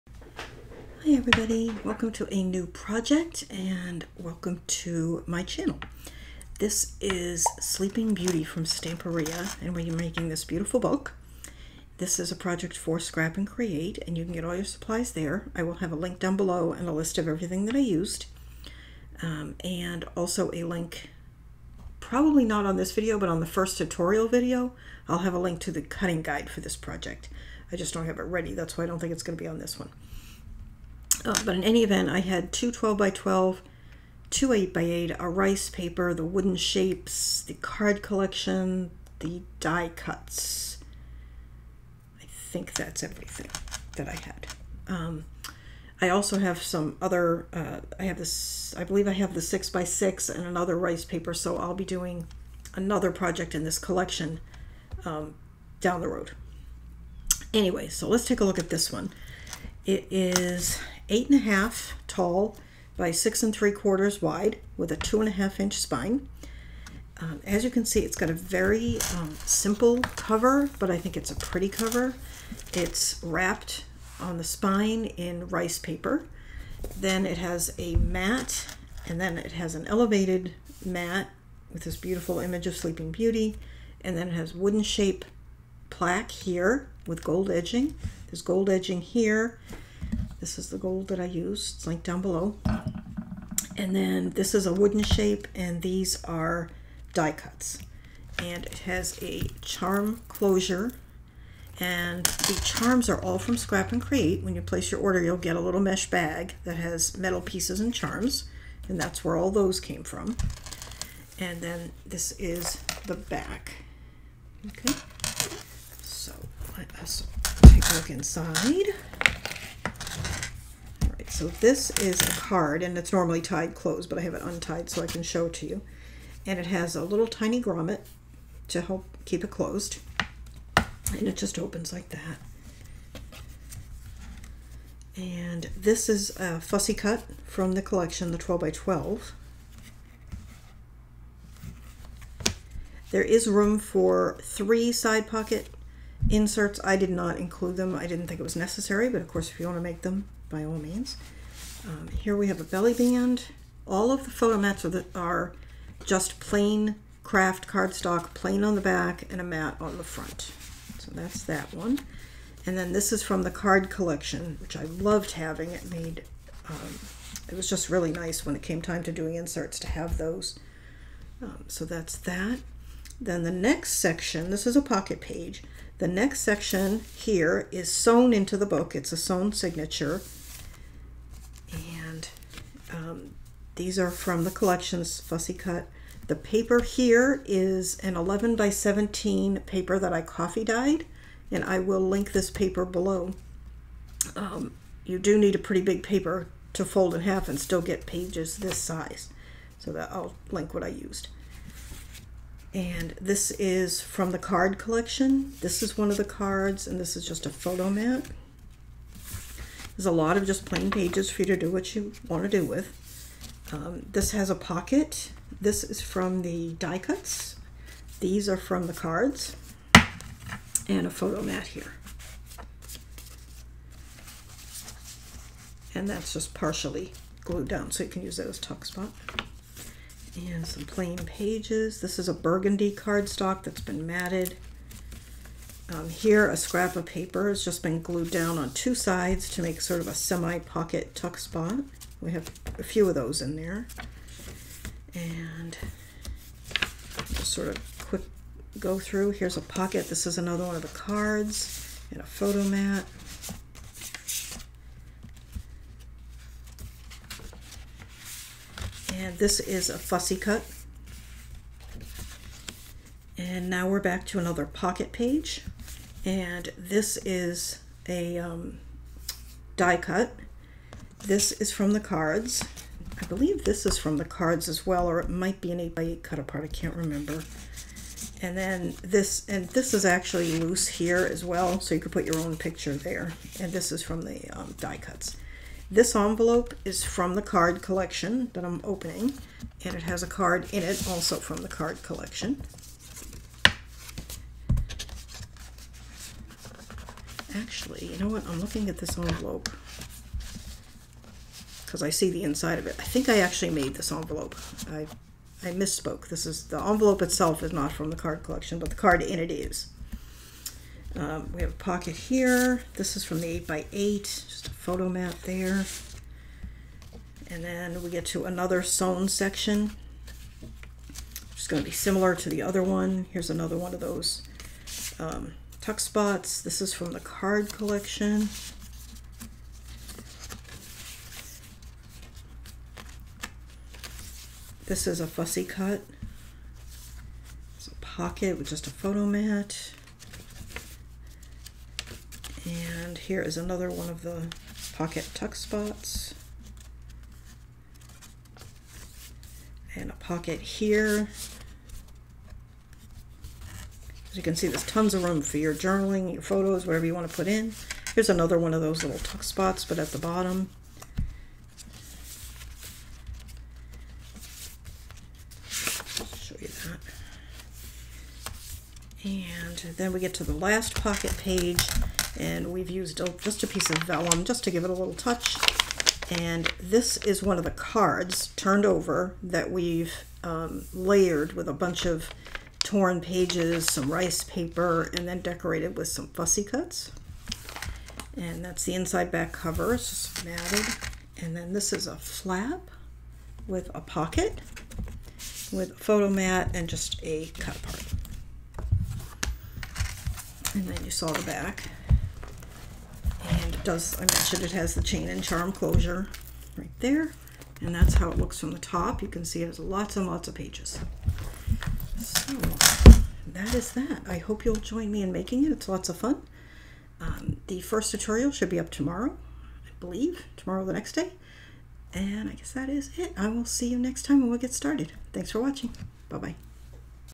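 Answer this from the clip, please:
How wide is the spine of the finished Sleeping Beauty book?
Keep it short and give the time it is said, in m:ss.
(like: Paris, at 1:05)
2.5 inches, at 1:04.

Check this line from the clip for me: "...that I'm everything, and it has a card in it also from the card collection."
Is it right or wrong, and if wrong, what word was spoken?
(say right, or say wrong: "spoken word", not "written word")
wrong: "opening", not "everything".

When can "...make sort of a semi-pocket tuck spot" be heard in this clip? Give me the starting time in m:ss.
3:59.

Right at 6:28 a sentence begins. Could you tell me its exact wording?
And that's the inside back cover, it's just matted.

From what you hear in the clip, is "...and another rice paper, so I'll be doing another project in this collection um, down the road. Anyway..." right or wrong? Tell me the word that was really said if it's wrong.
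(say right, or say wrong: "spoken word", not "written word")
right.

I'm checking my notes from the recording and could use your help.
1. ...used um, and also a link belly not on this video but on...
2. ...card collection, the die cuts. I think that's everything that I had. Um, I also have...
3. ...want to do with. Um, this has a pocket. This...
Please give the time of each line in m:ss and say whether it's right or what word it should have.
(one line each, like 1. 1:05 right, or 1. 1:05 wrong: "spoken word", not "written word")
1. 0:17 wrong: "probably", not "belly"
2. 0:37 right
3. 3:32 right.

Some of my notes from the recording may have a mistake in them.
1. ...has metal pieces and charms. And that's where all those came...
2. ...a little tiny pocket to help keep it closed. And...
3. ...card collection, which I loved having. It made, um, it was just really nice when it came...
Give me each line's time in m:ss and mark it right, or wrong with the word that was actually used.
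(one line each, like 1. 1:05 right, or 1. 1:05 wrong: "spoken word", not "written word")
1. 1:46 right
2. 2:06 wrong: "grommet", not "pocket"
3. 2:43 right.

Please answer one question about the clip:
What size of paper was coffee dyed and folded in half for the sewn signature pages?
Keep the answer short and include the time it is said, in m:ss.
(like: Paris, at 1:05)
11 by 17, at 3:08.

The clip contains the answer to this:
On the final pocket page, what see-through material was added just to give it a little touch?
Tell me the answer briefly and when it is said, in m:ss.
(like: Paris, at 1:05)
Vellum, at 6:14.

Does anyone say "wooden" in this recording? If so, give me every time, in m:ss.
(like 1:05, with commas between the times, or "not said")
0:36, 1:24, 1:34.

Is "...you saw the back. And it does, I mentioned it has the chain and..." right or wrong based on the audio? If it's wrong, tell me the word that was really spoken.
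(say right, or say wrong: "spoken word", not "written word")
right.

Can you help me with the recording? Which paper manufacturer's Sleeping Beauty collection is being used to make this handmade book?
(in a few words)
Stamperia.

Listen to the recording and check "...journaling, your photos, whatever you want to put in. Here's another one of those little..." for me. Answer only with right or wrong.
right.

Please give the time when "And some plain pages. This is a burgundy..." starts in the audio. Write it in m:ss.
3:50.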